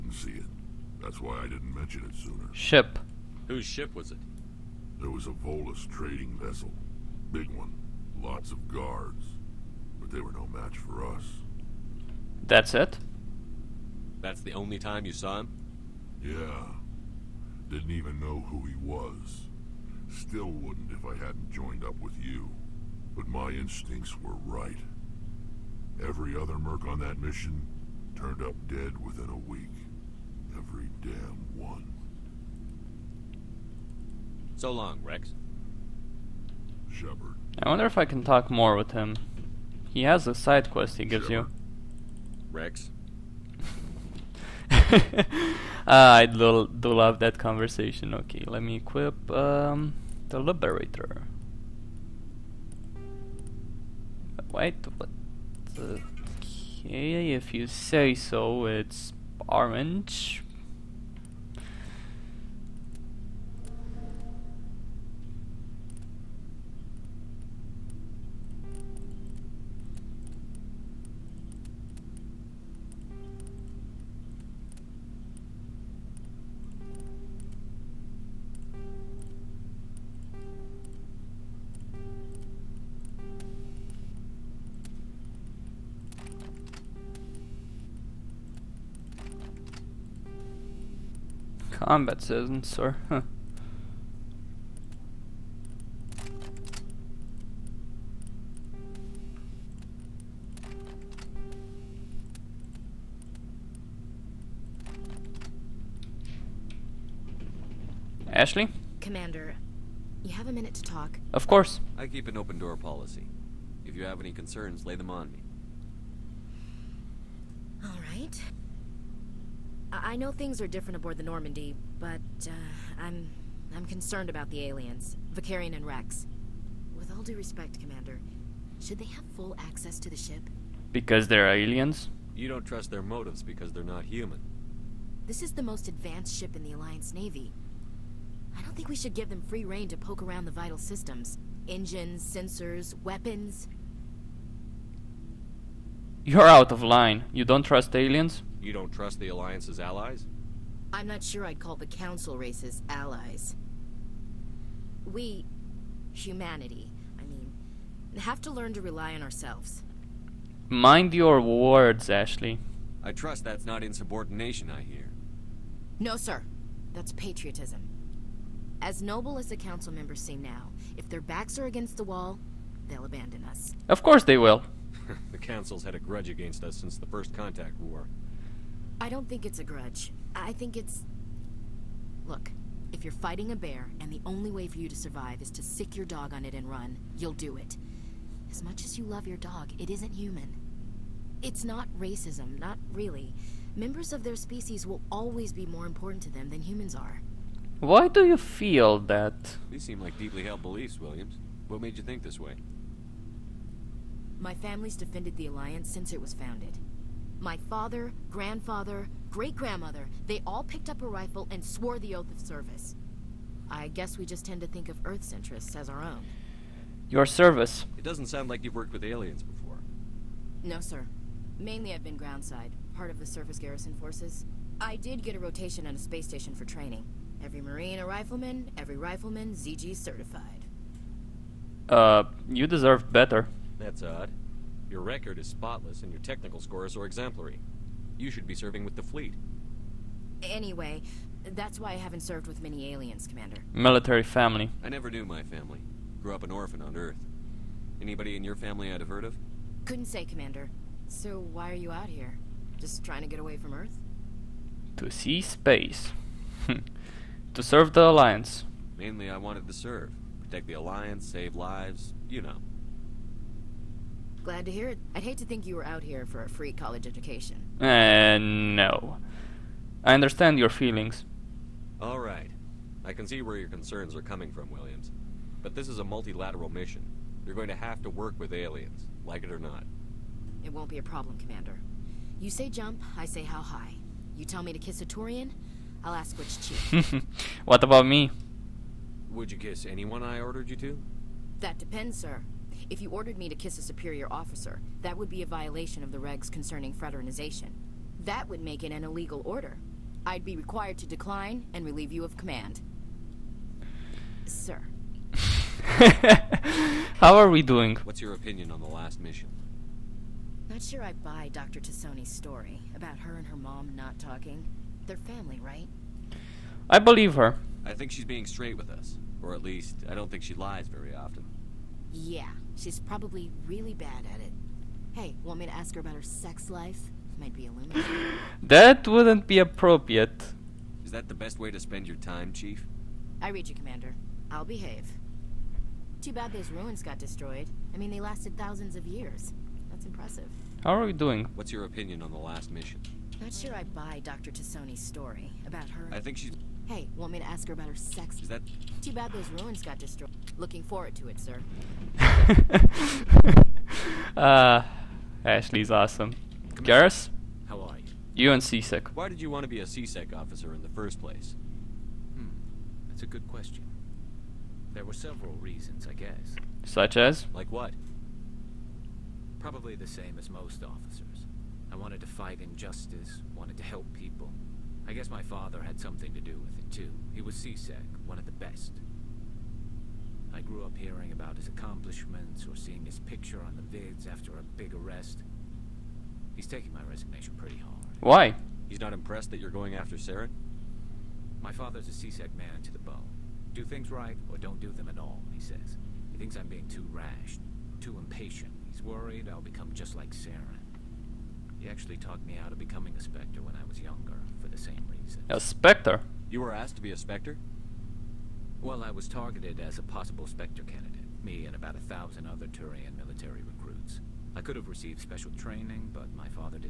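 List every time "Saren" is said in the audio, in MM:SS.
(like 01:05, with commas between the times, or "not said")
06:30, 06:40.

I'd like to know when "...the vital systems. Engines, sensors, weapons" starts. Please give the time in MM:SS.
02:20.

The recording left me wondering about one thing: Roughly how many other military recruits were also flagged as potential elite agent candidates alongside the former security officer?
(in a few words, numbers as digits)
1000.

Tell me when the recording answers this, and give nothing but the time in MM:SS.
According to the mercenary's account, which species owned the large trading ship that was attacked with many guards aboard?
00:05.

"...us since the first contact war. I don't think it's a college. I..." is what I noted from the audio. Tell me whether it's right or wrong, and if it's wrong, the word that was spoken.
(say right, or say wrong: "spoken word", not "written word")
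wrong: "grudge", not "college".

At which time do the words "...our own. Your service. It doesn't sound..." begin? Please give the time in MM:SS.
03:35.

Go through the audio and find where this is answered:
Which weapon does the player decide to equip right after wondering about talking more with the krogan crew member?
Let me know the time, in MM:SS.
00:50.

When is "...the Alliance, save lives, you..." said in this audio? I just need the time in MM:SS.
04:20.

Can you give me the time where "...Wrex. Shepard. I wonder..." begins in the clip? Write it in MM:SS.
00:35.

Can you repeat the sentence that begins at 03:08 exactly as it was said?
As much as you love your dog, it isn't human.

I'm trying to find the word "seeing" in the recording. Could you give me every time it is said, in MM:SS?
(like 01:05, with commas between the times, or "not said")
06:22.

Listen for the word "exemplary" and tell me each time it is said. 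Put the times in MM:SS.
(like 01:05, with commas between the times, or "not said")
03:57.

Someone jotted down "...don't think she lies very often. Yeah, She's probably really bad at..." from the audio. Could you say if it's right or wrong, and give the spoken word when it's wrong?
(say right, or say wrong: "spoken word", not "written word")
right.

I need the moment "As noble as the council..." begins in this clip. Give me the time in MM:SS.
02:48.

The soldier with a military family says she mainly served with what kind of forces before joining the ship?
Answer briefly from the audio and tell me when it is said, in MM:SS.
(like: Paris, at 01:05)
surface garrison forces, at 03:43.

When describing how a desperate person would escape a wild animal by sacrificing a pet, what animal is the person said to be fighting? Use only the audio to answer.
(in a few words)
bear.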